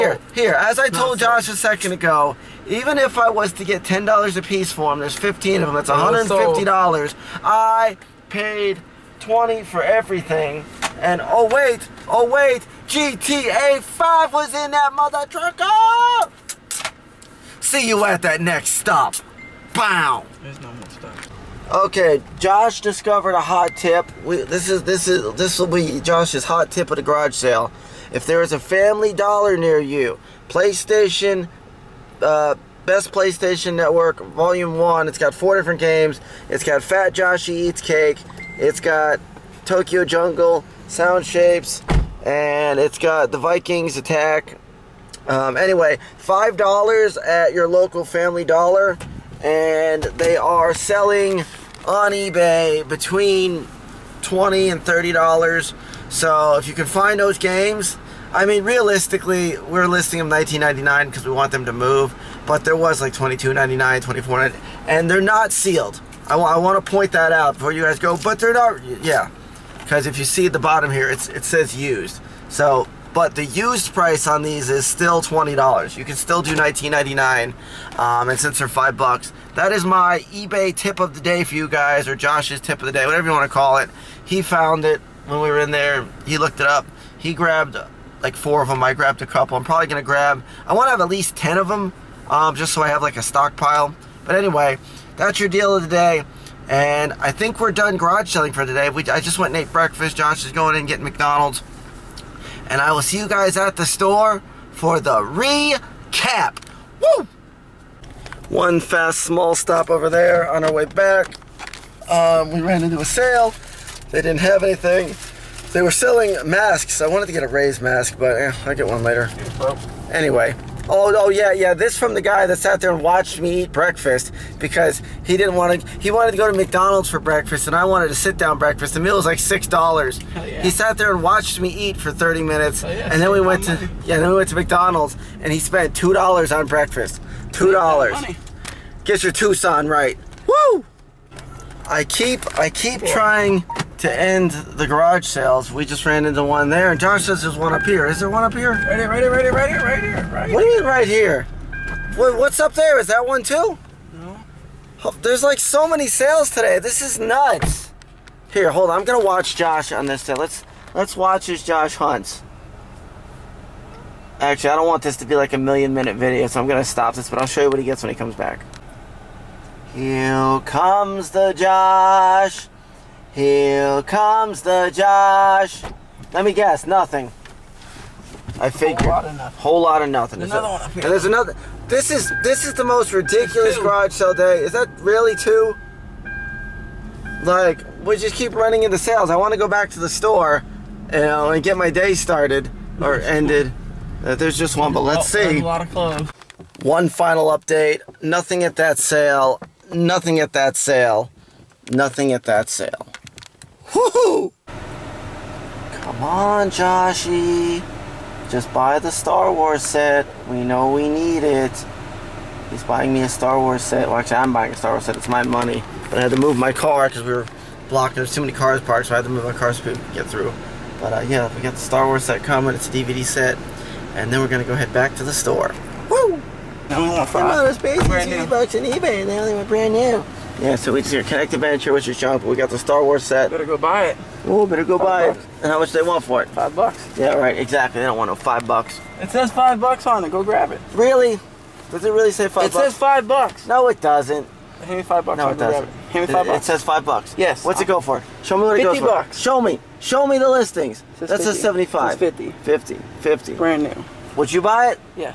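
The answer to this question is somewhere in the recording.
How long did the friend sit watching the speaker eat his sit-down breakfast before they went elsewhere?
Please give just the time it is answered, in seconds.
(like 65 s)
132 s.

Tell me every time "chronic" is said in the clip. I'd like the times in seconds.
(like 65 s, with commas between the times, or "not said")
not said.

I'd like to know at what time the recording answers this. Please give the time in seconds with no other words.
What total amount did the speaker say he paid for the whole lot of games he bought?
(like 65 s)
9 s.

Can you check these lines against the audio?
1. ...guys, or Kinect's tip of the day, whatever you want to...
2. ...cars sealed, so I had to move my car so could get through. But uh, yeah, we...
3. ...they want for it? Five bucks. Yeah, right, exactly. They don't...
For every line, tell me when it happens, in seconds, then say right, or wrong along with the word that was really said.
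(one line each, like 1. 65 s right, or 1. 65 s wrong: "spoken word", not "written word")
1. 81 s wrong: "Josh", not "Kinect"
2. 218 s wrong: "parked", not "sealed"
3. 235 s right.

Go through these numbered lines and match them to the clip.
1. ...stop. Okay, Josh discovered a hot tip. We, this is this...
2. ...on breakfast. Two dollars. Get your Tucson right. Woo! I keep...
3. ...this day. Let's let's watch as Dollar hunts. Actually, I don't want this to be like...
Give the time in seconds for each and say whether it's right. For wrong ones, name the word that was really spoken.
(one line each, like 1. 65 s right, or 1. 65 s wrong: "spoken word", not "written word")
1. 20 s right
2. 136 s right
3. 160 s wrong: "Josh", not "Dollar".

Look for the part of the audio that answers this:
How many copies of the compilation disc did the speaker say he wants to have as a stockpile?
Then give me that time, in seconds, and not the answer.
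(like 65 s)
91 s.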